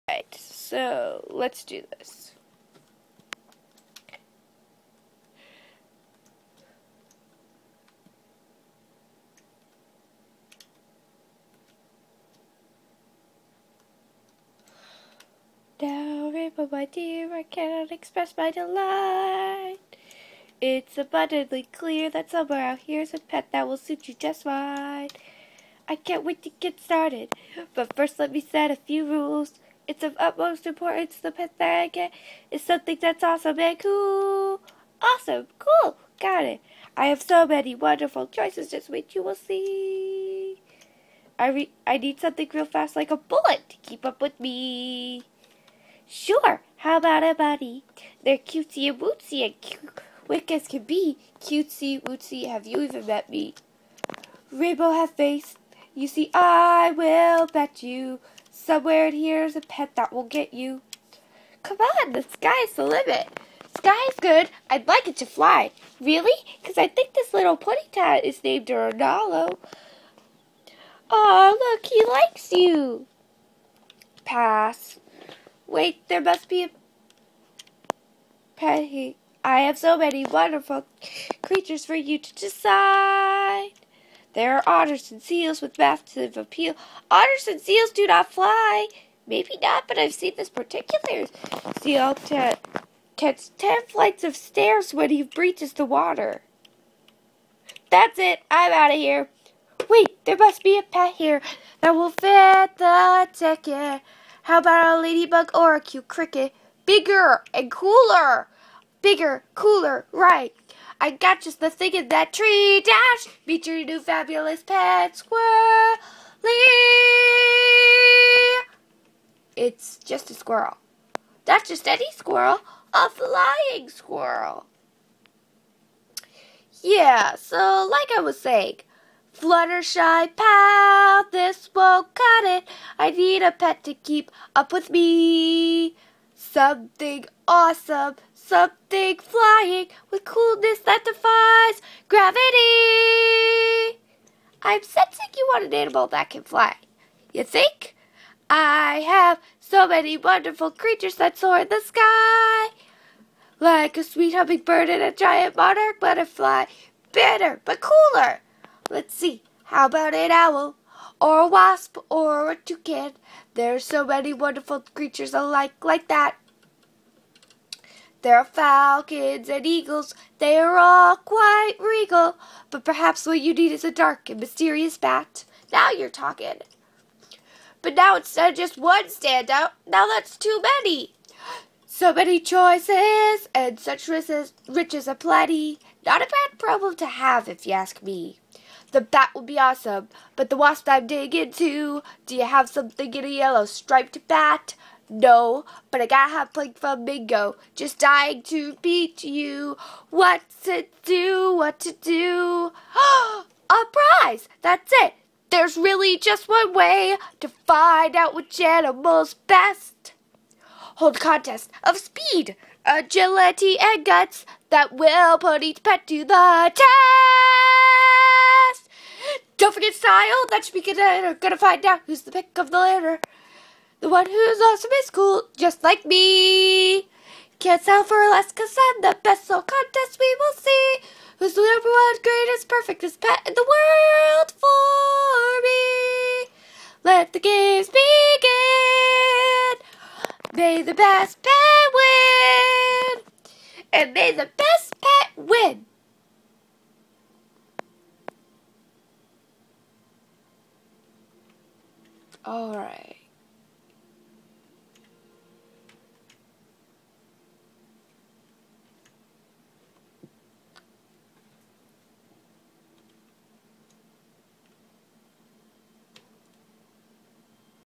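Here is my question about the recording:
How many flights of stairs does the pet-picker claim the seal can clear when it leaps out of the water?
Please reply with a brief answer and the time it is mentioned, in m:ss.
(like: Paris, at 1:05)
10, at 1:33.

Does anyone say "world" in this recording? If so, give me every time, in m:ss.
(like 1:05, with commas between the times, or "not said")
3:53.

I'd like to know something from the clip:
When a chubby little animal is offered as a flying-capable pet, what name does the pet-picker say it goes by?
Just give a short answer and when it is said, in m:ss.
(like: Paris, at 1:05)
Ronaldo, at 1:08.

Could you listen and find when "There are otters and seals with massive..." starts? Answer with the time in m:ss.
1:24.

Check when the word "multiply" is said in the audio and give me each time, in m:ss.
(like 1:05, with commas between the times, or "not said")
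not said.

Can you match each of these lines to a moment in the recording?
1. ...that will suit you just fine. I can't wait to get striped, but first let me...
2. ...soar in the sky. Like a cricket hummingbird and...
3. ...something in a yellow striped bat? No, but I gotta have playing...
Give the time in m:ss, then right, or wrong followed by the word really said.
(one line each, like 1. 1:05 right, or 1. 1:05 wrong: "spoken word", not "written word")
1. 0:23 wrong: "started", not "striped"
2. 2:31 wrong: "sweet", not "cricket"
3. 3:12 right.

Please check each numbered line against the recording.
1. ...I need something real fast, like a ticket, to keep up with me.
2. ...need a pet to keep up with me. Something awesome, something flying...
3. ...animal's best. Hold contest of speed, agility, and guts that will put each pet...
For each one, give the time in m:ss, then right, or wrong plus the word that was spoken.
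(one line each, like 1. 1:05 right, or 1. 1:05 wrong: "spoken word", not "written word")
1. 0:41 wrong: "bullet", not "ticket"
2. 2:13 right
3. 3:28 right.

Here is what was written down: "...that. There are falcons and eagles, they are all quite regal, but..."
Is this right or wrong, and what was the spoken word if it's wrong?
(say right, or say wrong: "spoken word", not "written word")
right.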